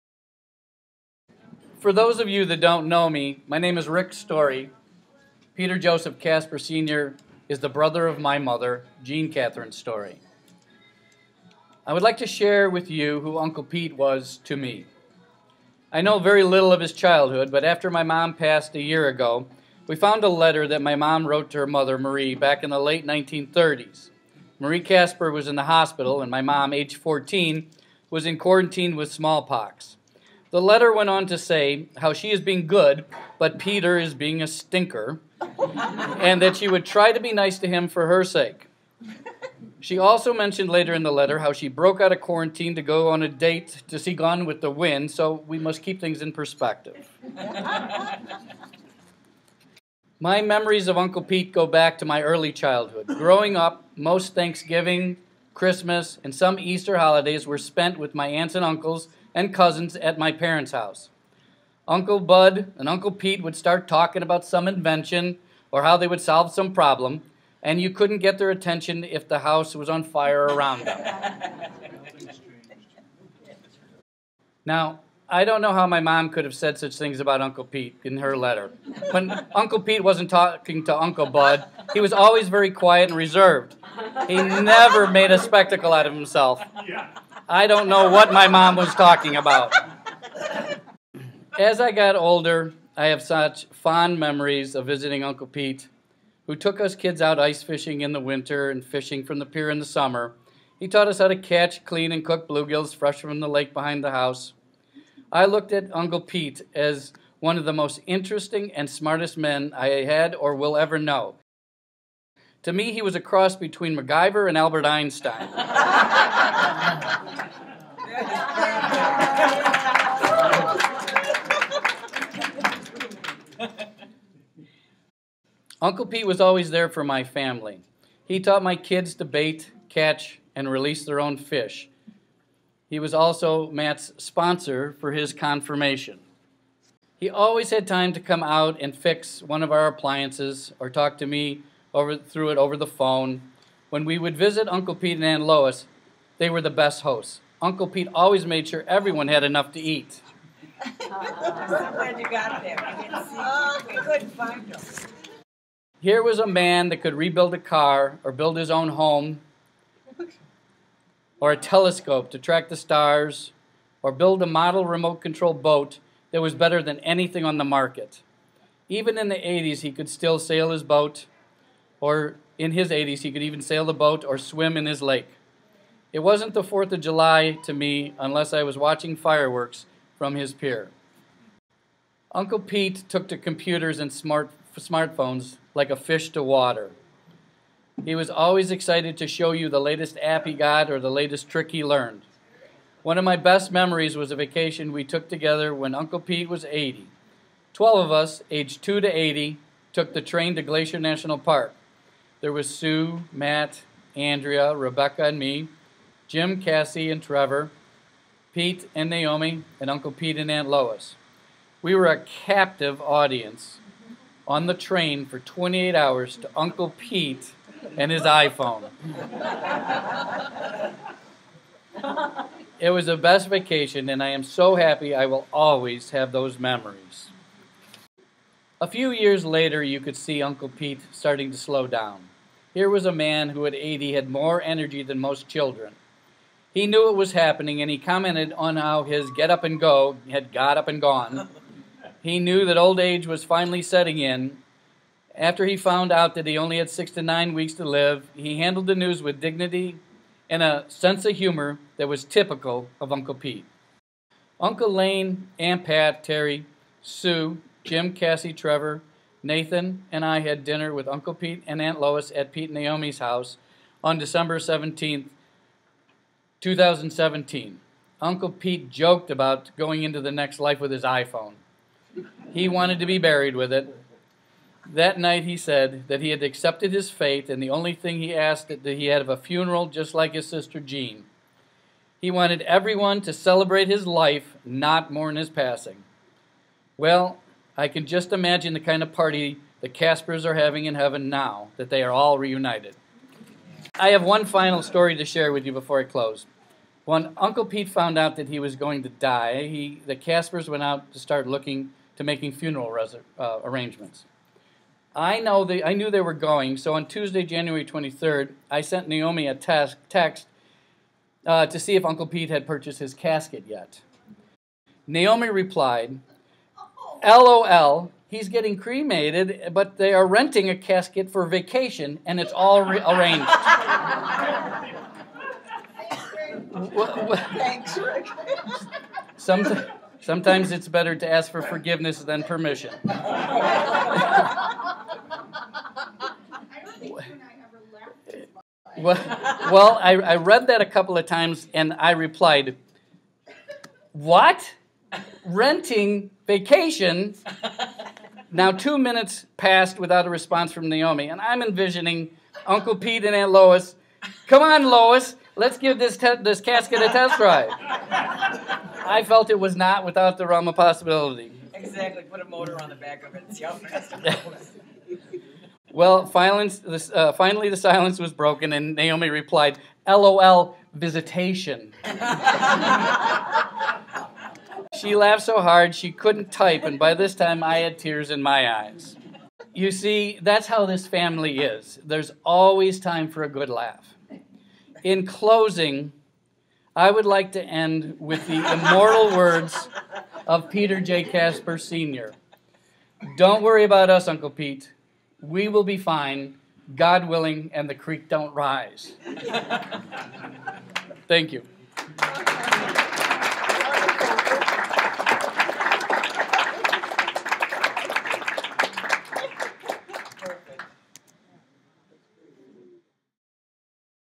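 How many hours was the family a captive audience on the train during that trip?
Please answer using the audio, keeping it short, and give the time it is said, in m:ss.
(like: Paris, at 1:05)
28, at 3:35.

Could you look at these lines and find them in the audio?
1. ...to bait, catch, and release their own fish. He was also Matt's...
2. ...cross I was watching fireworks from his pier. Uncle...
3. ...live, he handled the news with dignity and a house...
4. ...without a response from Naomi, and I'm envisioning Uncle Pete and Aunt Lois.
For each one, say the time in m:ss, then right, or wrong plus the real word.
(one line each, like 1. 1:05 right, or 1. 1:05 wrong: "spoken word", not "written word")
1. 2:09 right
2. 2:58 wrong: "unless", not "cross"
3. 4:07 wrong: "sense", not "house"
4. 5:49 right.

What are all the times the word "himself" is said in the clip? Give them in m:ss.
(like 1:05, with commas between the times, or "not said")
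1:26.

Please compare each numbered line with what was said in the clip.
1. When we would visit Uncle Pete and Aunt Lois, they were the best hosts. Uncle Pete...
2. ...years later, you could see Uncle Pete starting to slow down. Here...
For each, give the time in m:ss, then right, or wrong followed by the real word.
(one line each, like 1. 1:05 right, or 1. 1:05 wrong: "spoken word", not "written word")
1. 2:23 right
2. 3:49 right.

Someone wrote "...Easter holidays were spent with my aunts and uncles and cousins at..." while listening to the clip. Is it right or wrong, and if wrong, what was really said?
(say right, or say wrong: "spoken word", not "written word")
right.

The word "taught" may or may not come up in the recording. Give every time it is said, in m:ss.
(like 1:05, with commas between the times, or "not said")
1:40, 2:08.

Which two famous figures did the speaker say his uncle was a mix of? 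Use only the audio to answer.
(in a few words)
MacGyver and Albert Einstein.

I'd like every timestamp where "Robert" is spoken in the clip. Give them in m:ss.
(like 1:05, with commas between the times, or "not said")
not said.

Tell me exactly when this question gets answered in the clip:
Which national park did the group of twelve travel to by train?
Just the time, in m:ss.
3:20.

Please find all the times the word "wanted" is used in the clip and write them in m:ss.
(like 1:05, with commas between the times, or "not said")
4:32, 4:42.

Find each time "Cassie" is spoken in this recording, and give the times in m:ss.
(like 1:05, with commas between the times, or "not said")
3:26, 4:18.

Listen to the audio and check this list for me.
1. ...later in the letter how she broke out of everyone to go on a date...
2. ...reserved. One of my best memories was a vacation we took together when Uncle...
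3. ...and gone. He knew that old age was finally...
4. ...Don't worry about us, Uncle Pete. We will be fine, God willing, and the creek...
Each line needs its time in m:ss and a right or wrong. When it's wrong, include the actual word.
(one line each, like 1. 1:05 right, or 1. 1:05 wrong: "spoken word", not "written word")
1. 0:40 wrong: "quarantine", not "everyone"
2. 3:11 wrong: "learned", not "reserved"
3. 4:00 right
4. 6:33 right.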